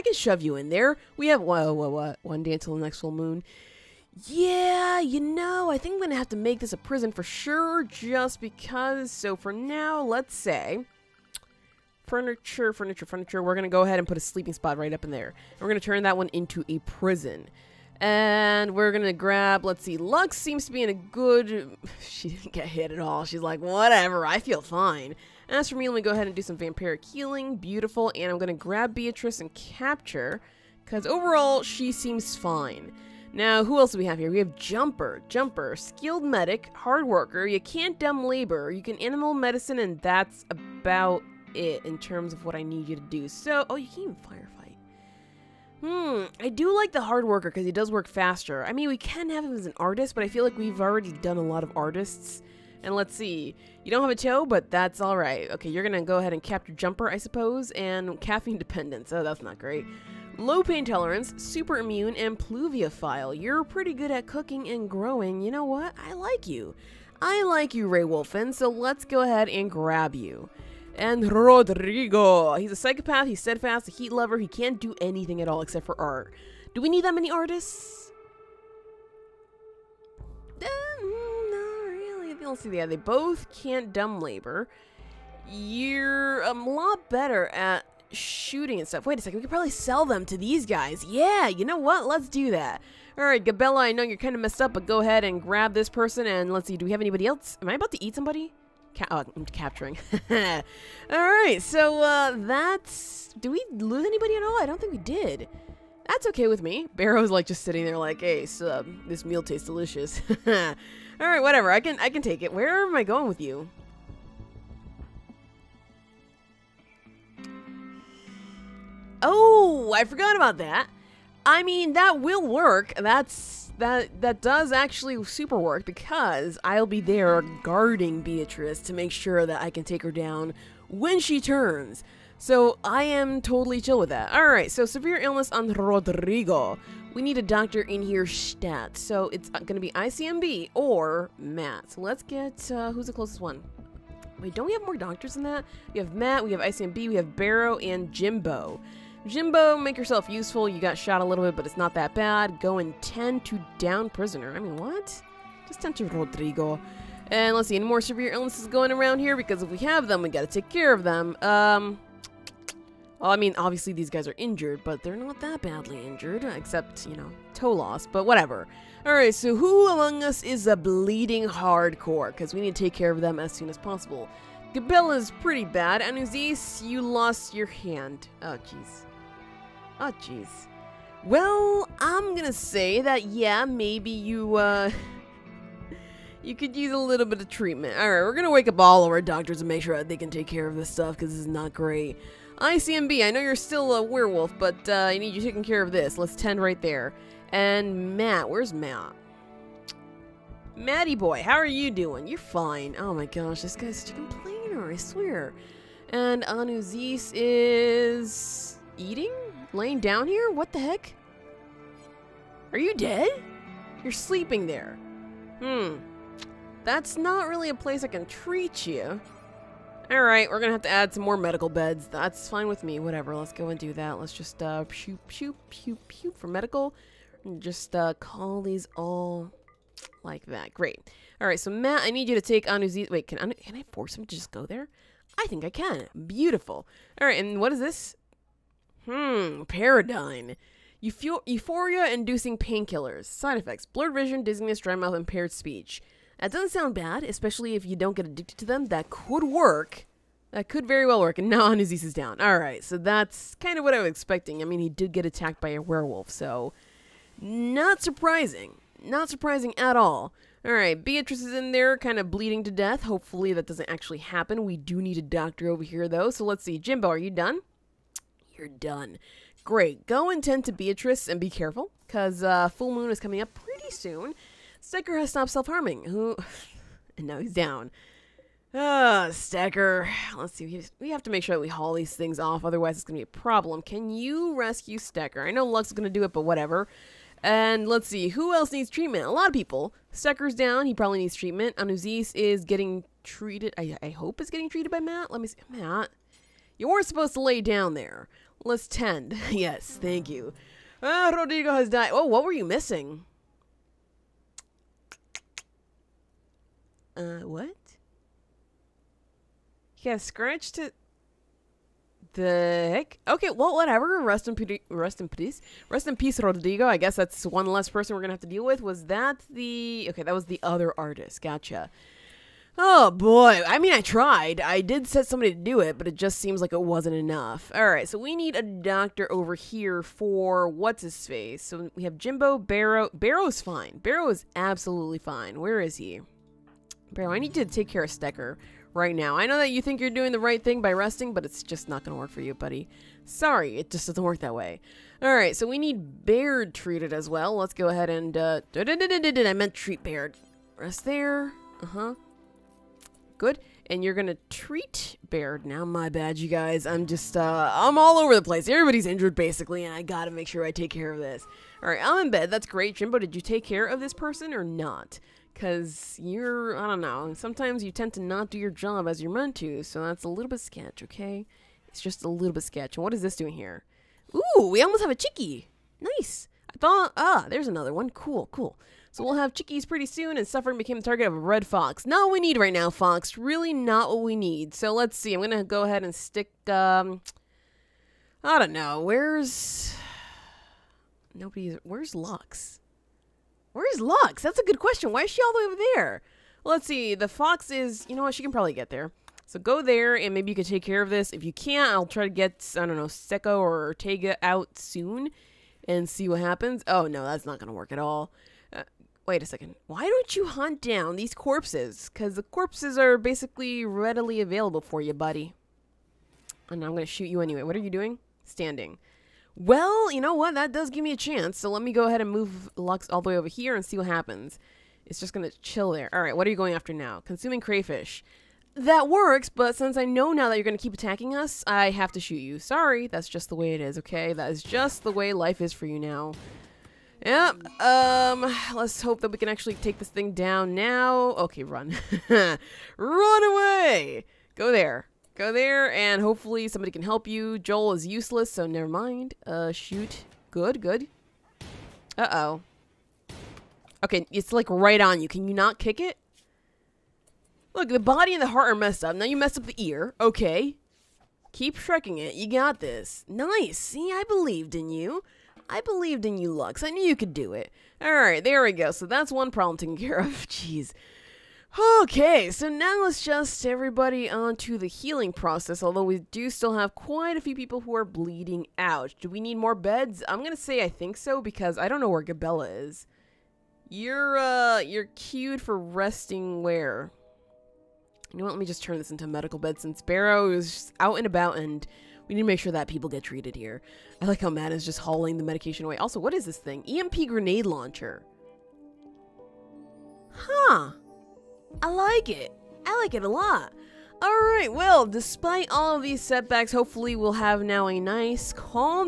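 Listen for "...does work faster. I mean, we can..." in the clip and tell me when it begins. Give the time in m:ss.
0:47.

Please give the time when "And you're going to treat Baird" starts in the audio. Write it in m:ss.
5:53.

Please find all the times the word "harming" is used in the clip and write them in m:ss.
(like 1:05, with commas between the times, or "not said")
4:35.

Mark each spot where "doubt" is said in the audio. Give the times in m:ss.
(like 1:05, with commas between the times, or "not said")
not said.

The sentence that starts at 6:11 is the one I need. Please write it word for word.
It's just a little bit sketch.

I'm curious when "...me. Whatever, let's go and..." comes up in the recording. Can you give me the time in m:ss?
3:42.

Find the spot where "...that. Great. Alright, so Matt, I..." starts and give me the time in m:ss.
3:50.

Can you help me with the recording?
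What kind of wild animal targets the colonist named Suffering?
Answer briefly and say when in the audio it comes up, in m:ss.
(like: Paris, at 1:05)
Red fox, at 6:21.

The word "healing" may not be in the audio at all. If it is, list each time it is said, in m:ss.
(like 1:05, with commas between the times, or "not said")
0:27, 7:54.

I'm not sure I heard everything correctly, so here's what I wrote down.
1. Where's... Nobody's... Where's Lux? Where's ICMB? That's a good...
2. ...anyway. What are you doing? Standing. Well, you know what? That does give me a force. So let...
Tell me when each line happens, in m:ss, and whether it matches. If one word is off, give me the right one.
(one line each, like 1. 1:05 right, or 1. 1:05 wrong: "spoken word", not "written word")
1. 6:28 wrong: "Lux", not "ICMB"
2. 6:57 wrong: "chance", not "force".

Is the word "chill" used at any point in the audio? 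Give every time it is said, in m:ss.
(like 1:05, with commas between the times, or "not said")
2:13, 7:05.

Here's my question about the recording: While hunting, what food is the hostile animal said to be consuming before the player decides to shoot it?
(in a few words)
Crayfish.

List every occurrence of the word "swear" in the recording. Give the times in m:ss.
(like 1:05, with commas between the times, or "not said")
3:24.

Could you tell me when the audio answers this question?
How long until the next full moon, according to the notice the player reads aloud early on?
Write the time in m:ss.
0:02.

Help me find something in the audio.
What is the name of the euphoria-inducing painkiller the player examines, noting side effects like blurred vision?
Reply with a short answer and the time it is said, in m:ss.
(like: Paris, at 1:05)
Paradigm, at 3:59.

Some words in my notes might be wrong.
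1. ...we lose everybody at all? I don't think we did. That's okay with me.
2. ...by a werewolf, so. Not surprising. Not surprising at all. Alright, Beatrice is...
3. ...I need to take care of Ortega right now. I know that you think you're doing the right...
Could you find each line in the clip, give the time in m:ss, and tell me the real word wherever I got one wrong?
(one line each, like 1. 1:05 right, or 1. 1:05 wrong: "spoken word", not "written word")
1. 1:43 wrong: "anybody", not "everybody"
2. 4:15 right
3. 5:37 wrong: "Stecker", not "Ortega".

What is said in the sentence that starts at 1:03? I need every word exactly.
You're pretty good at cooking and growing.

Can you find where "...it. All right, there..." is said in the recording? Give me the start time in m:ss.
7:47.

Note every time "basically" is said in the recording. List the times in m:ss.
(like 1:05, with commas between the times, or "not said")
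5:59, 6:53.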